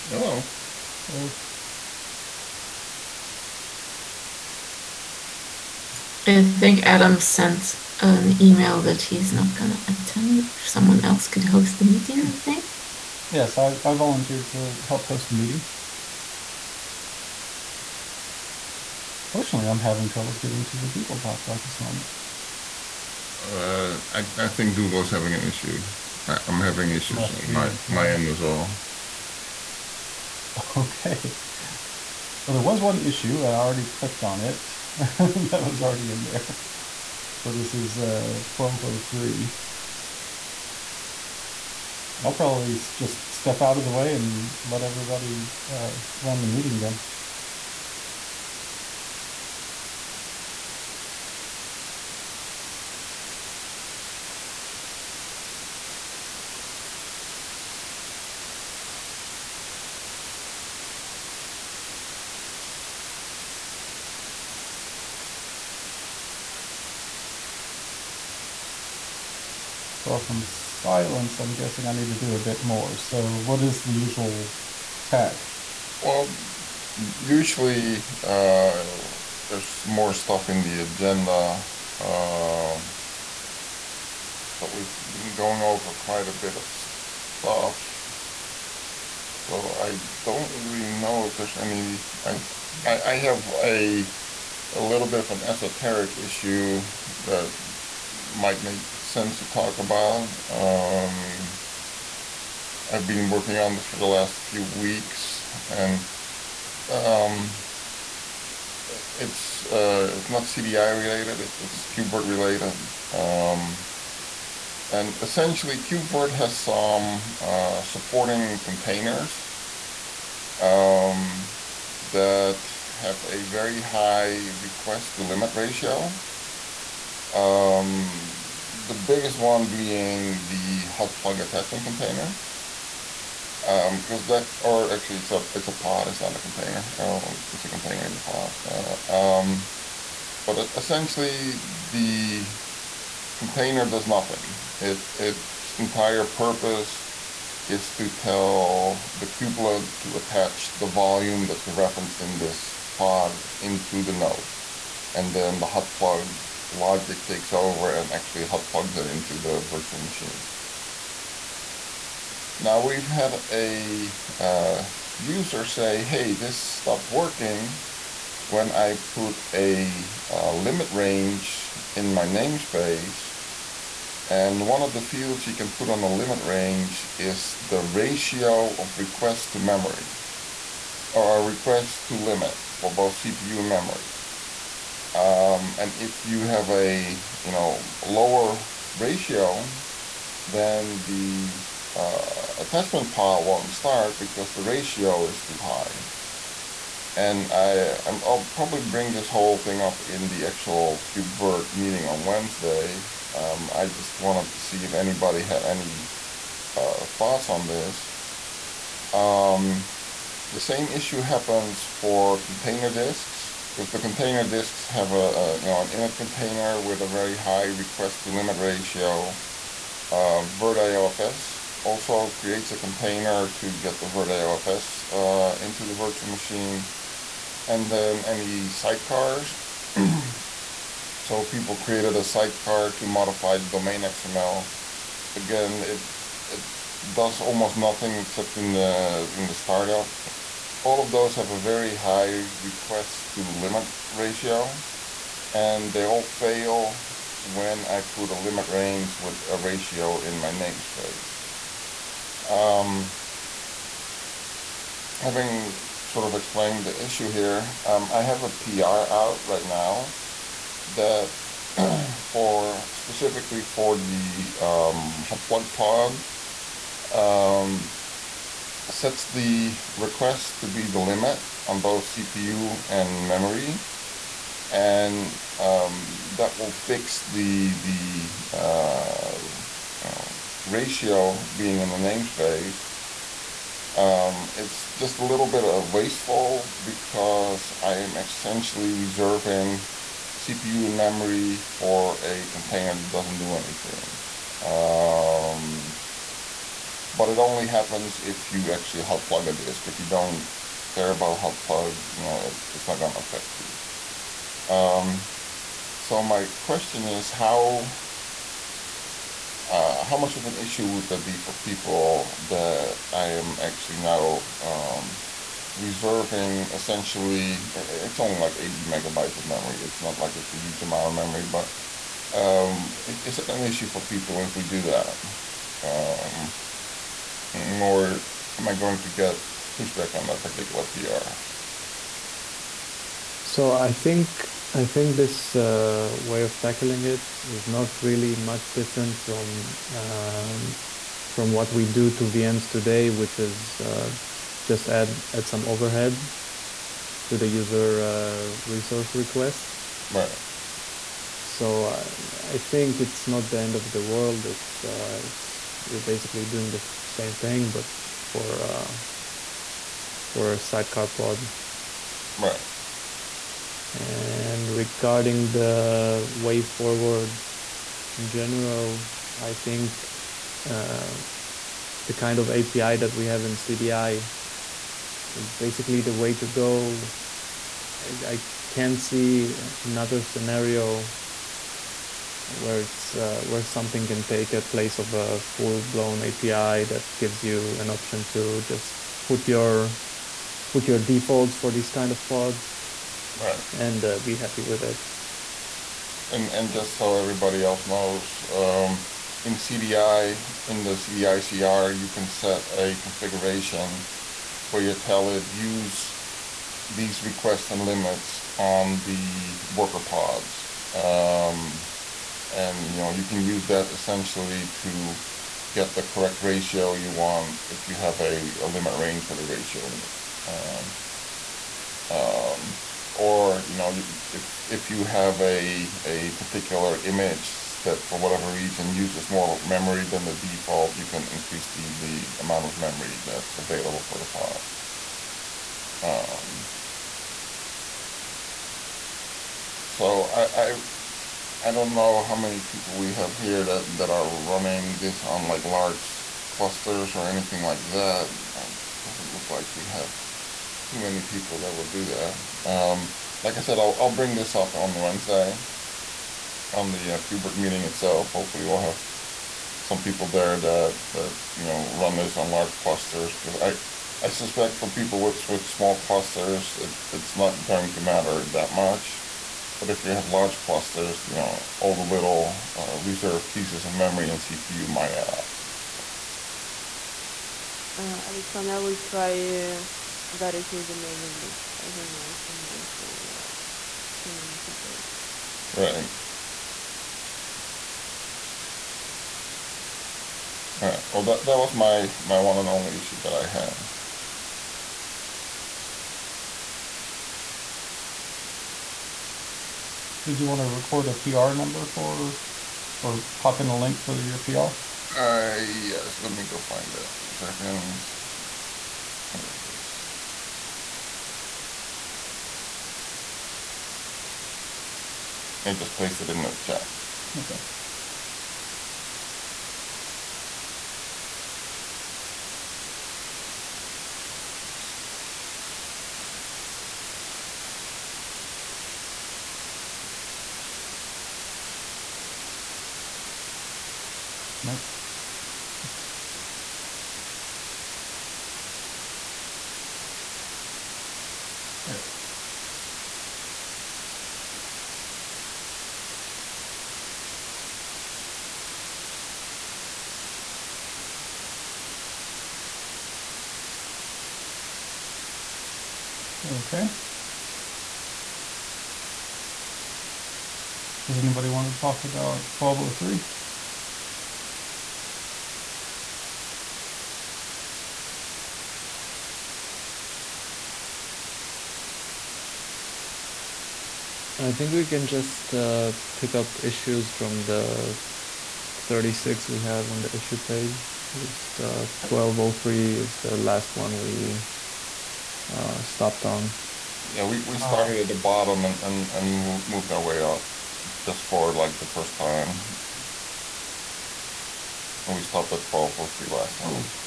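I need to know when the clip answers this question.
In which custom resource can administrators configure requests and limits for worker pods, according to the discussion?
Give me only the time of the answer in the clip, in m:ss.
6:40.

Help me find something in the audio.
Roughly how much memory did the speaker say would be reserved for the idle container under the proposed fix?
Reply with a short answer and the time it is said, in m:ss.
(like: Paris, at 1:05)
80 megabytes, at 5:18.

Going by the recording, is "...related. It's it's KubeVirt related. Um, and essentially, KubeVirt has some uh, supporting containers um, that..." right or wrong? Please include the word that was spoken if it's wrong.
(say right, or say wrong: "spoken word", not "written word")
right.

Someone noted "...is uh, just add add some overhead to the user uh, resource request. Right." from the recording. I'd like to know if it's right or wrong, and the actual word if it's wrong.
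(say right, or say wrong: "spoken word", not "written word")
right.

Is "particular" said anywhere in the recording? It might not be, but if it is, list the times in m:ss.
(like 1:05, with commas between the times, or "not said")
5:30, 7:06.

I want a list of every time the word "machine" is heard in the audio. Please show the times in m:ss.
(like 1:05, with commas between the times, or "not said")
2:40, 3:46.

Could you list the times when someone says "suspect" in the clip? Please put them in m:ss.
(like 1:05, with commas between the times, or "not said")
7:44.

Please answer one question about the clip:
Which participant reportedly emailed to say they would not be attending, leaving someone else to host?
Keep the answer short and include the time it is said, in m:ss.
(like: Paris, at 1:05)
Adam, at 0:06.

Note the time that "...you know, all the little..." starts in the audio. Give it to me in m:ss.
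7:51.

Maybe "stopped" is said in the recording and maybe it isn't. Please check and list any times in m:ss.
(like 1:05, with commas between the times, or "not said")
2:46, 9:45, 9:55.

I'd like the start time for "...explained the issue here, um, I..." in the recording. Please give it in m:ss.
4:16.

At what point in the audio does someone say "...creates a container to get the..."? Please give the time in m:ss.
3:42.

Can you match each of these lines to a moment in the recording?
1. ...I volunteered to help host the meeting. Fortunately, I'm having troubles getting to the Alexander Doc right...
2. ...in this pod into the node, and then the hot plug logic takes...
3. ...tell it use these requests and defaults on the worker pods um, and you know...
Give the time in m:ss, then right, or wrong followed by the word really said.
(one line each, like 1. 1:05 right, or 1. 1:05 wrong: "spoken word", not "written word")
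1. 0:13 wrong: "Google", not "Alexander"
2. 2:32 right
3. 6:44 wrong: "limits", not "defaults".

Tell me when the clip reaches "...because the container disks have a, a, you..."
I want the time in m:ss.
3:33.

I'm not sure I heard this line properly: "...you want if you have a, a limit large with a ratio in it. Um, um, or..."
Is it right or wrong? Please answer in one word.
wrong.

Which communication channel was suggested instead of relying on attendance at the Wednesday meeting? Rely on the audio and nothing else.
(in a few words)
mailing list.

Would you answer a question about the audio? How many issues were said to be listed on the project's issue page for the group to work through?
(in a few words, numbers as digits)
36.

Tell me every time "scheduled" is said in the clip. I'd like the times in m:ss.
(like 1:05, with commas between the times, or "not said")
not said.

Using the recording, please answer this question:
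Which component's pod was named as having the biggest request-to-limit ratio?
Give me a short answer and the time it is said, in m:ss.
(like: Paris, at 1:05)
hot plug attachment container, at 2:10.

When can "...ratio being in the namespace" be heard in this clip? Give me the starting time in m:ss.
4:40.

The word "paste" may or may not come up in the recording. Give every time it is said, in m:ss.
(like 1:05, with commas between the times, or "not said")
8:35.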